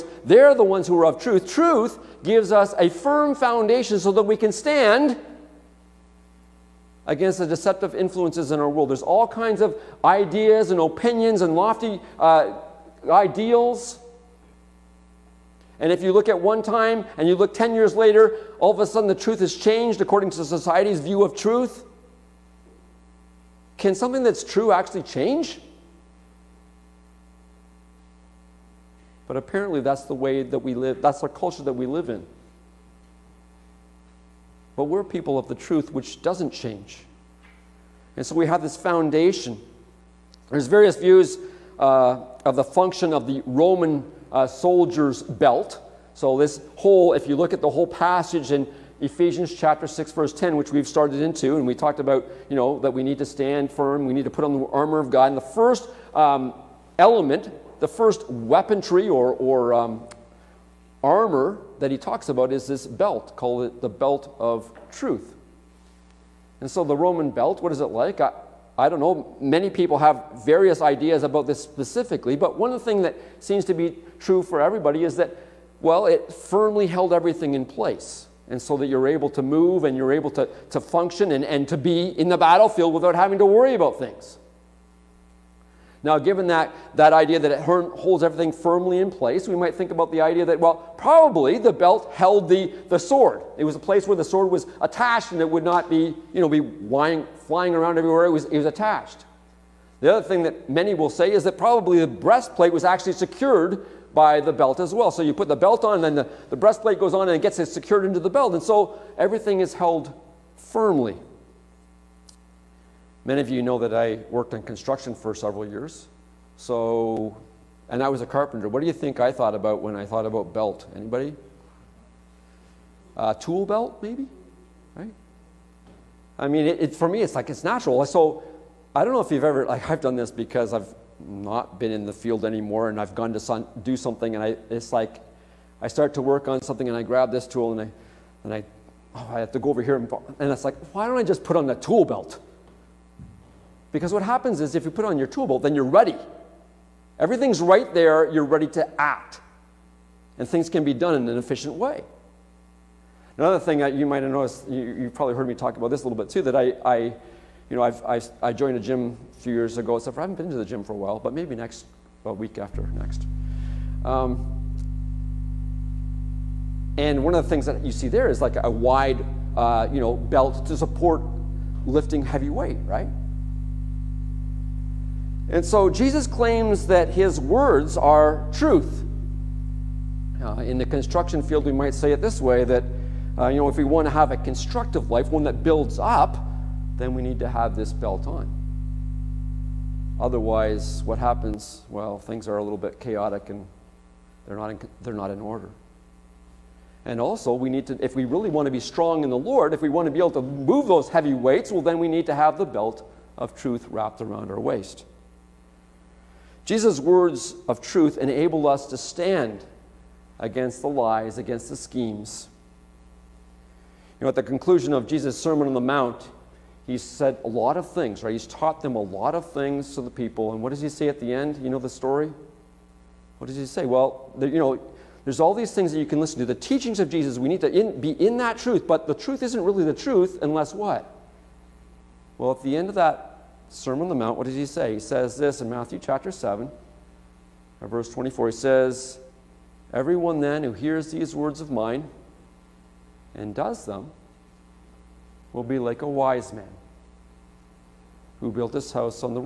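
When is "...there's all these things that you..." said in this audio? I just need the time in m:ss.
3:45.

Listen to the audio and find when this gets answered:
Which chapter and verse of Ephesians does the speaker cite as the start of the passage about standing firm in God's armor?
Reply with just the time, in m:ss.
0:49.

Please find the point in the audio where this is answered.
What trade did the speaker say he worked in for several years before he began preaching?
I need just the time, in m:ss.
1:58.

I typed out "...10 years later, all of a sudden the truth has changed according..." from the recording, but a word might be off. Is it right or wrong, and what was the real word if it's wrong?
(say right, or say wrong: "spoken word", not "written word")
right.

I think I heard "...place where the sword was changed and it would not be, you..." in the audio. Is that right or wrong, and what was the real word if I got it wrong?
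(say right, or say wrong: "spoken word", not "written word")
wrong: "attached", not "changed".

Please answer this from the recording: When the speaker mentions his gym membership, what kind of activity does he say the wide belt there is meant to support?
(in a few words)
Lifting heavy weight.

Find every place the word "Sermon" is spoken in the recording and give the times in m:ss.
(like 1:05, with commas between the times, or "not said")
3:35, 3:53.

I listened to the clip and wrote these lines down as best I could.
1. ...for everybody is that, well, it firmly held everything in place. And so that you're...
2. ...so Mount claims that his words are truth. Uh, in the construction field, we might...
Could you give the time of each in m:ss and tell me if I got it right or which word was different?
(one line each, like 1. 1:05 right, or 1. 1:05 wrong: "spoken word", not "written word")
1. 1:14 right
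2. 2:55 wrong: "Jesus", not "Mount".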